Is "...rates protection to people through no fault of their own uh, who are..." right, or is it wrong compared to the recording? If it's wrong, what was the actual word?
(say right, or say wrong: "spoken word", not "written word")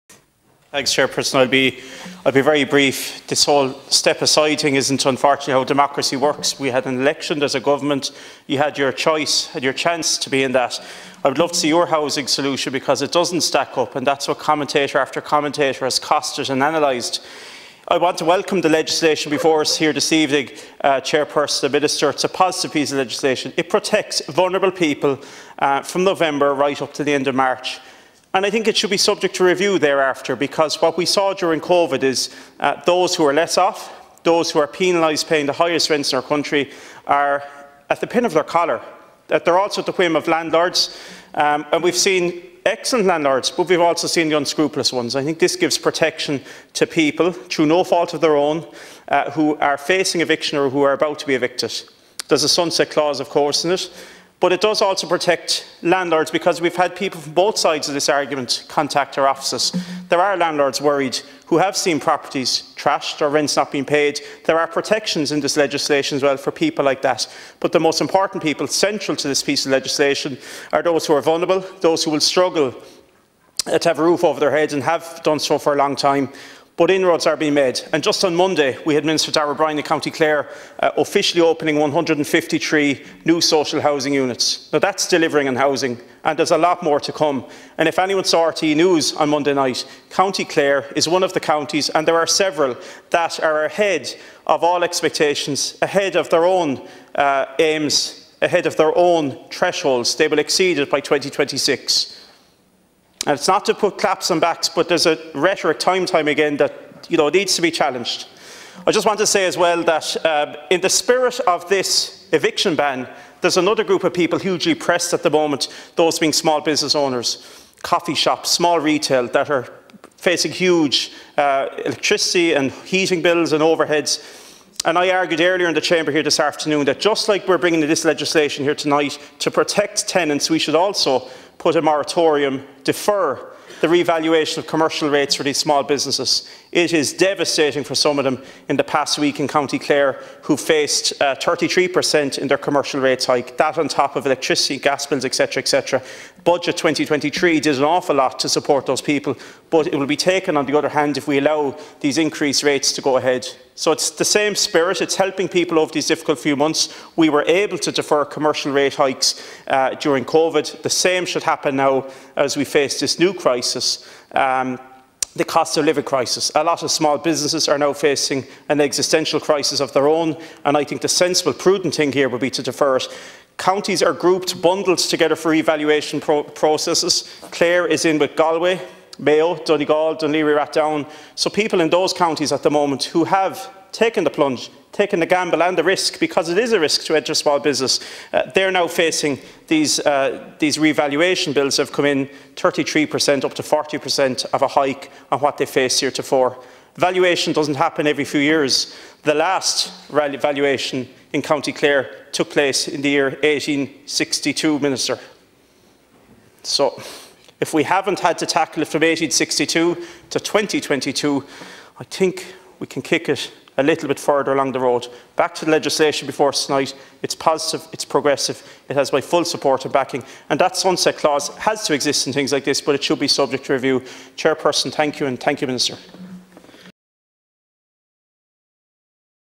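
wrong: "gives", not "rates".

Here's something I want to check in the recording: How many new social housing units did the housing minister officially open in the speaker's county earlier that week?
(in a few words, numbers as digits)
153.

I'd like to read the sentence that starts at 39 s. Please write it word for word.
That uh, they're also at the whim of landlords.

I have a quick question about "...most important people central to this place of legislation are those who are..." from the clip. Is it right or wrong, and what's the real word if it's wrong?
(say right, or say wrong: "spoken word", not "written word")
wrong: "piece", not "place".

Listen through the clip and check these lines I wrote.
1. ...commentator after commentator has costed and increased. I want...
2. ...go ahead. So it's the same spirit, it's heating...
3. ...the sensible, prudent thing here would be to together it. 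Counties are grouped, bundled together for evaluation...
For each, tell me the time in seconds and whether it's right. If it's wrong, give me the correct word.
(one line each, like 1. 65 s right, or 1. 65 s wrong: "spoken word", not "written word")
1. 14 s wrong: "analysed", not "increased"
2. 153 s wrong: "helping", not "heating"
3. 171 s wrong: "defer", not "together".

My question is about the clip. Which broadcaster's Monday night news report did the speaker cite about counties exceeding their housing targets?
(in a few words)
RTE.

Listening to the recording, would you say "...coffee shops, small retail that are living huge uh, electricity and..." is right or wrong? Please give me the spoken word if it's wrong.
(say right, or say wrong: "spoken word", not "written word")
wrong: "facing", not "living".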